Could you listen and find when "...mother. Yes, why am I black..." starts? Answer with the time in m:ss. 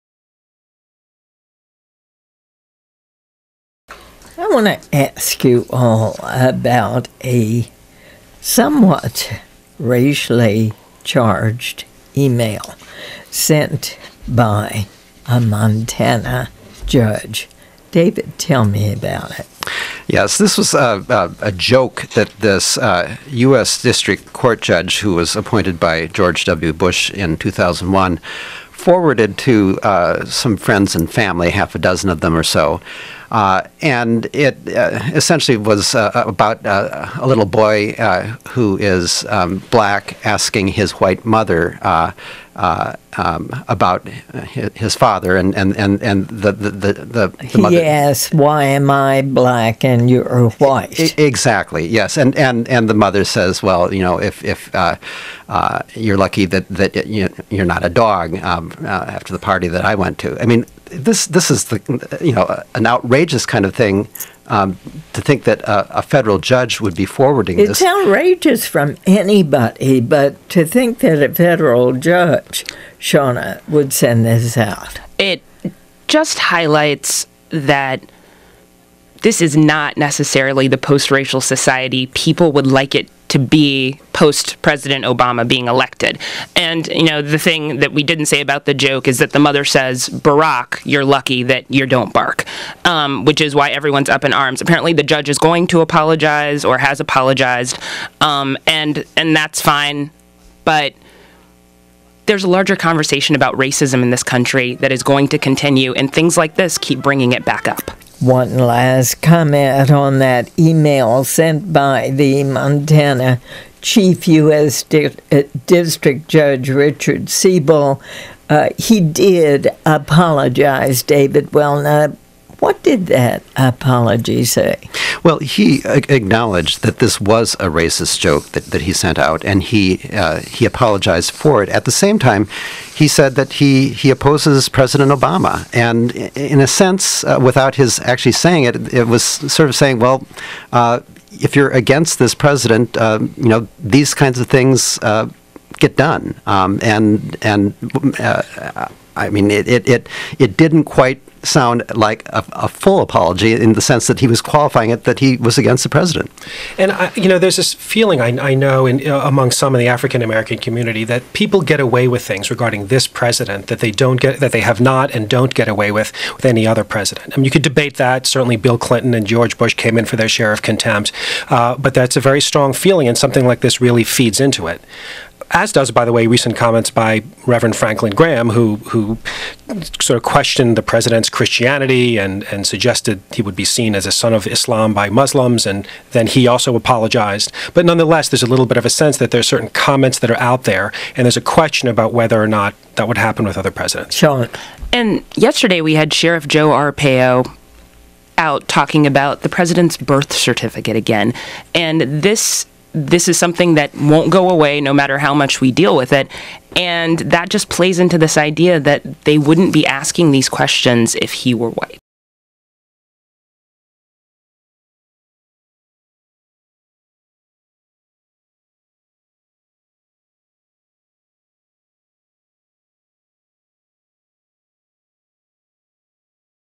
0:47.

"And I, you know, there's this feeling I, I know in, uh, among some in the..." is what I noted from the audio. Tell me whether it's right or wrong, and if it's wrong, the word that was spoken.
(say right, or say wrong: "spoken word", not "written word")
right.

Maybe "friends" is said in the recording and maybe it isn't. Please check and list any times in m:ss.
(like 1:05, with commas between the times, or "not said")
0:30.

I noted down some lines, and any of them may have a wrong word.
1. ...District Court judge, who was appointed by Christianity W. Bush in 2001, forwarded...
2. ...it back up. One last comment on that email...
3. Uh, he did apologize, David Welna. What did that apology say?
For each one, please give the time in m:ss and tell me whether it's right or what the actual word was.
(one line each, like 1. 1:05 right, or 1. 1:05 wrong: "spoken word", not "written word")
1. 0:23 wrong: "George", not "Christianity"
2. 1:47 right
3. 1:58 right.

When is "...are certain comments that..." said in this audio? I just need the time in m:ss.
3:09.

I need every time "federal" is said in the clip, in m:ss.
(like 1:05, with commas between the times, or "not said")
1:06, 1:11.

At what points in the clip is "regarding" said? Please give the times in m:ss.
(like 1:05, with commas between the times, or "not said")
2:42.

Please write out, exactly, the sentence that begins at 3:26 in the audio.
And that just plays into this idea that they wouldn't be asking these questions if he were white.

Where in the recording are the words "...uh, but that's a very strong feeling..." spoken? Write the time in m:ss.
2:51.